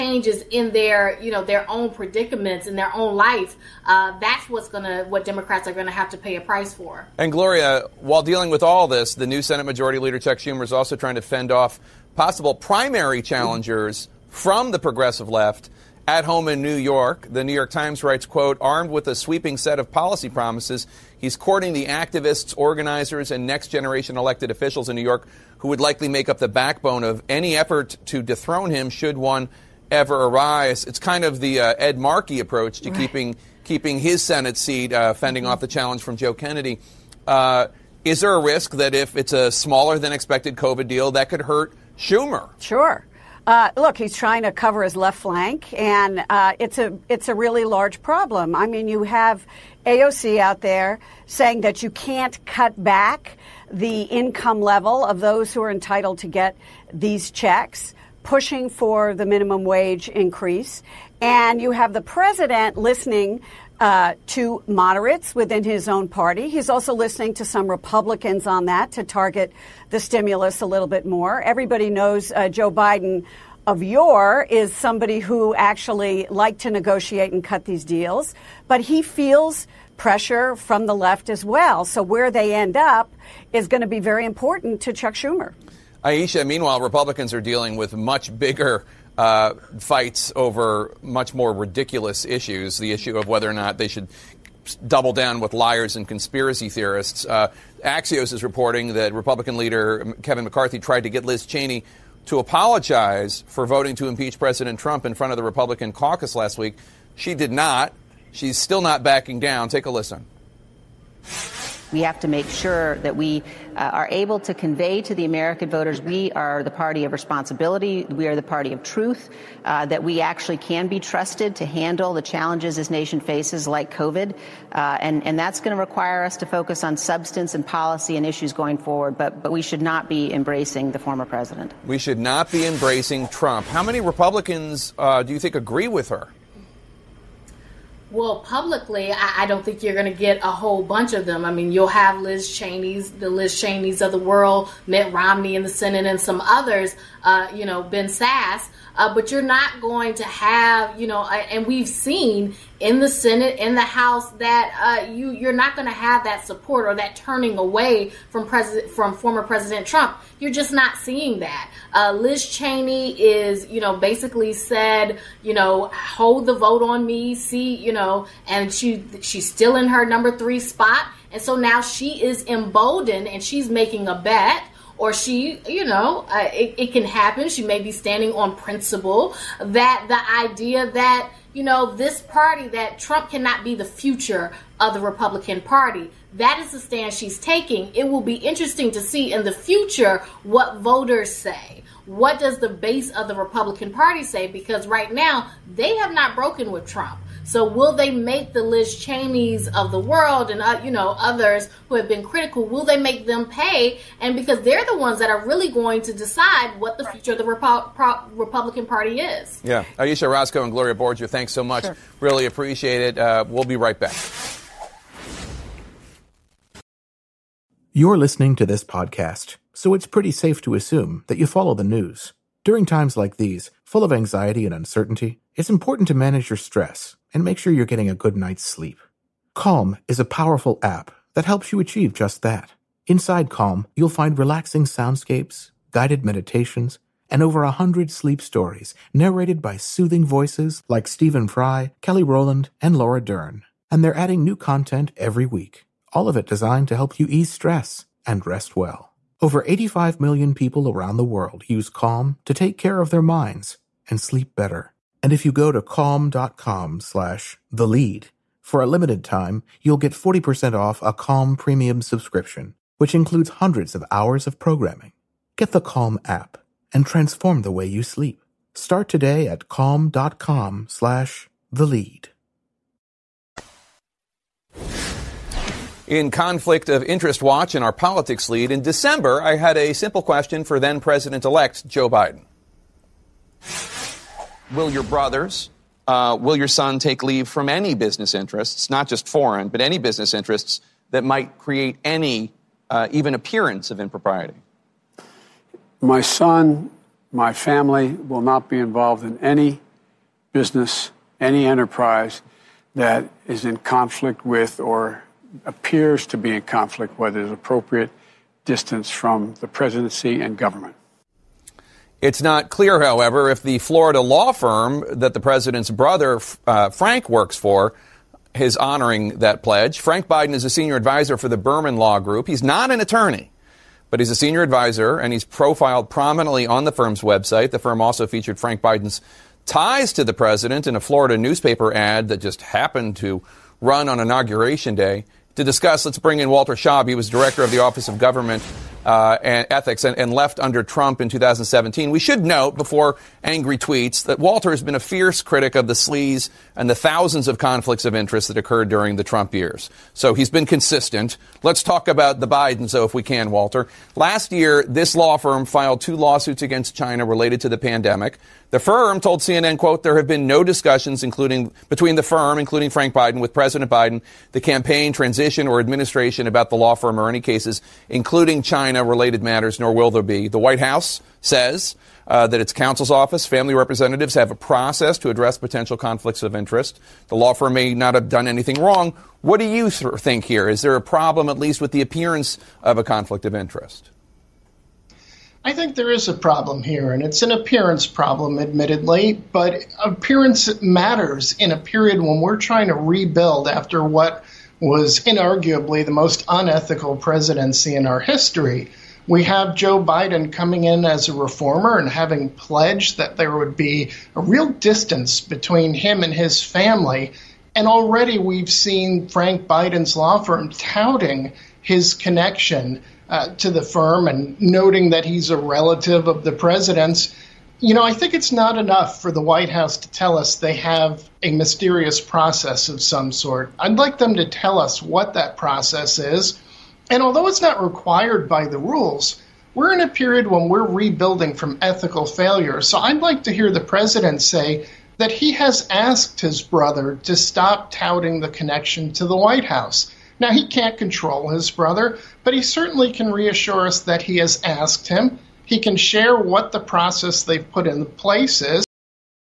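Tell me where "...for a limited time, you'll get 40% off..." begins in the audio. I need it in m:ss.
4:18.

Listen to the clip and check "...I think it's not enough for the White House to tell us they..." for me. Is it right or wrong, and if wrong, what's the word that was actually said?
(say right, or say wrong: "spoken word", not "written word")
right.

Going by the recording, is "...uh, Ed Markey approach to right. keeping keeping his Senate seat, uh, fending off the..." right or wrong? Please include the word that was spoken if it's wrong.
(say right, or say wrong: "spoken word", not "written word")
right.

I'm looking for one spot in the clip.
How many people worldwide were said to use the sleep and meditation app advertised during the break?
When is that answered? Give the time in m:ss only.
4:09.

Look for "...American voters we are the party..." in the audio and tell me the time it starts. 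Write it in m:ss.
1:55.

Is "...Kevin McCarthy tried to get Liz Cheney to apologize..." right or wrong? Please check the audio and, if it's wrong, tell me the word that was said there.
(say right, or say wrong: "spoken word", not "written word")
right.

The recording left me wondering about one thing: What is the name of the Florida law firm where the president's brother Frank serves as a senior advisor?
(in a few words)
Berman Law Group.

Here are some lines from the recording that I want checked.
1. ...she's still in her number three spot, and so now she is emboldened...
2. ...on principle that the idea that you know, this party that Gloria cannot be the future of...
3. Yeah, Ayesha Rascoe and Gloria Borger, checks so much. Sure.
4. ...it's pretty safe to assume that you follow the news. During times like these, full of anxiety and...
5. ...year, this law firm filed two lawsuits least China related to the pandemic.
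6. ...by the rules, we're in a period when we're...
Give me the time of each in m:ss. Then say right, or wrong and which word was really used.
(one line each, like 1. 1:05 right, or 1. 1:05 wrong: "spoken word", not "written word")
1. 2:49 right
2. 2:58 wrong: "Trump", not "Gloria"
3. 3:29 wrong: "thanks", not "checks"
4. 3:39 right
5. 5:54 wrong: "against", not "least"
6. 7:08 right.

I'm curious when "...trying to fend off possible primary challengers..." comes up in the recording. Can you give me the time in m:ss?
0:10.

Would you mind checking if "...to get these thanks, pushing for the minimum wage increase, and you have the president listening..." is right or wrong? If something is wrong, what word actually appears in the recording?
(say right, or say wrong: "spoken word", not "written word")
wrong: "checks", not "thanks".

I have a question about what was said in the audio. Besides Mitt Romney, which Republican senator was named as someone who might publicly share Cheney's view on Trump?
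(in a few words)
Ben Sasse.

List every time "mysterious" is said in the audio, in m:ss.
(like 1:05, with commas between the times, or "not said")
7:01.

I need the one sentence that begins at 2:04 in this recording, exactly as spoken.
Uh, and, and that's going to require us to focus on substance and policy and issues going forward.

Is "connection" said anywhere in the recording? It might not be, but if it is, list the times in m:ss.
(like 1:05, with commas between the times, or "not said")
6:52, 7:18.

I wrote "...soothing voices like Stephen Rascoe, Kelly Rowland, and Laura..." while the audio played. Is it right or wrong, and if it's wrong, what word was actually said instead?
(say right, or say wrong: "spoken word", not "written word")
wrong: "Fry", not "Rascoe".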